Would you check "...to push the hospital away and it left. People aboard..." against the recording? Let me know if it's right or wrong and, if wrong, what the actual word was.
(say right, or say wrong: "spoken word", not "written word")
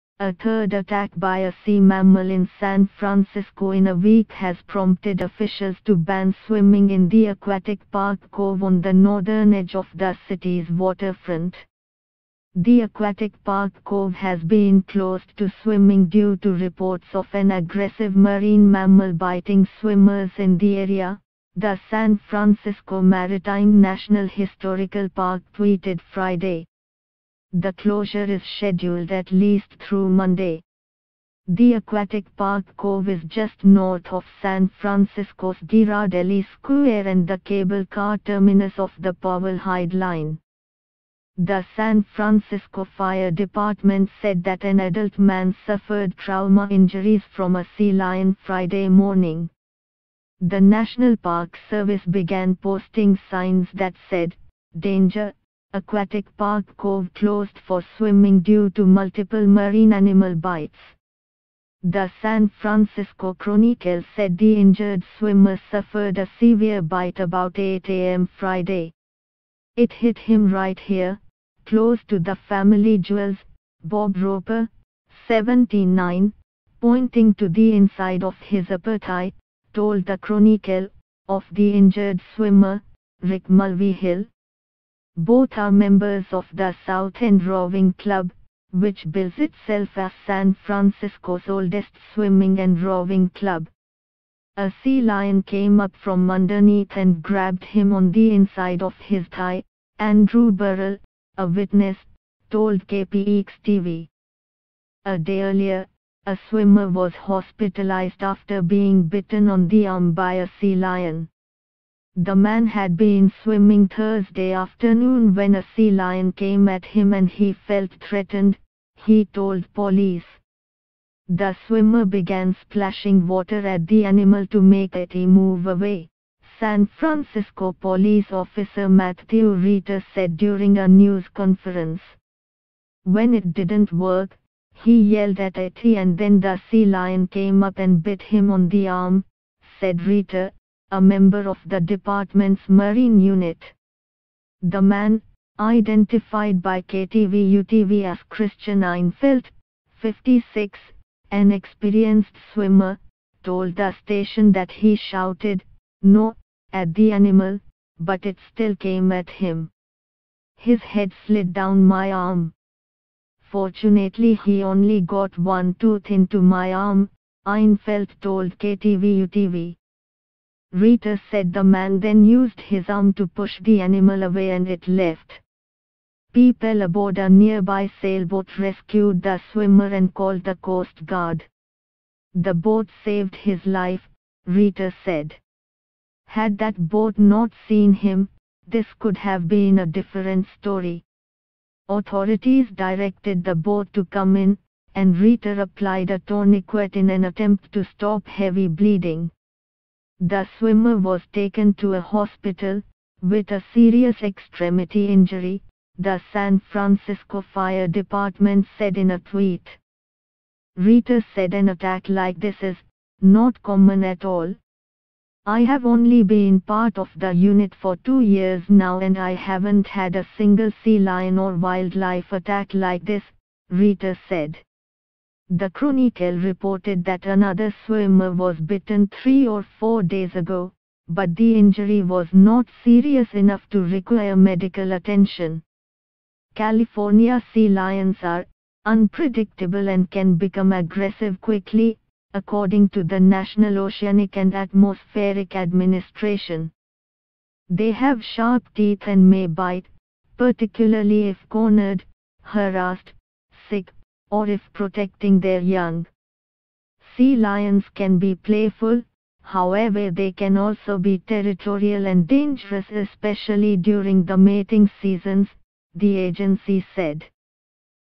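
wrong: "animal", not "hospital".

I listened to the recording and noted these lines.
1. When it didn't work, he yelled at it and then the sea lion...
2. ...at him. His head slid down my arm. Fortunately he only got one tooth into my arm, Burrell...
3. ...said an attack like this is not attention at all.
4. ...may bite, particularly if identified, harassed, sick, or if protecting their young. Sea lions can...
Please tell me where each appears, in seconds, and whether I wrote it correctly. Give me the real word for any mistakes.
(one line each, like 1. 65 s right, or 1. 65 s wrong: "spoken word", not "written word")
1. 133 s right
2. 159 s wrong: "Einfeld", not "Burrell"
3. 211 s wrong: "common", not "attention"
4. 249 s wrong: "cornered", not "identified".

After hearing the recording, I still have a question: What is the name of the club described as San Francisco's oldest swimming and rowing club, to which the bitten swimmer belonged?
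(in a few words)
South End Rowing Club.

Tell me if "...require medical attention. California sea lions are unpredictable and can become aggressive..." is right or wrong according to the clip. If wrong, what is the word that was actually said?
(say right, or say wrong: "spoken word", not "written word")
right.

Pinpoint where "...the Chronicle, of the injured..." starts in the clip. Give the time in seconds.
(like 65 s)
80 s.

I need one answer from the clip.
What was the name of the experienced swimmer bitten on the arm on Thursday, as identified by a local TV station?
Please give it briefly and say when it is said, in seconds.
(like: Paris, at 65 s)
Christian Einfeld, at 148 s.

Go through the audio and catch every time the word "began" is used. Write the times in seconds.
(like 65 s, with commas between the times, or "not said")
52 s, 122 s.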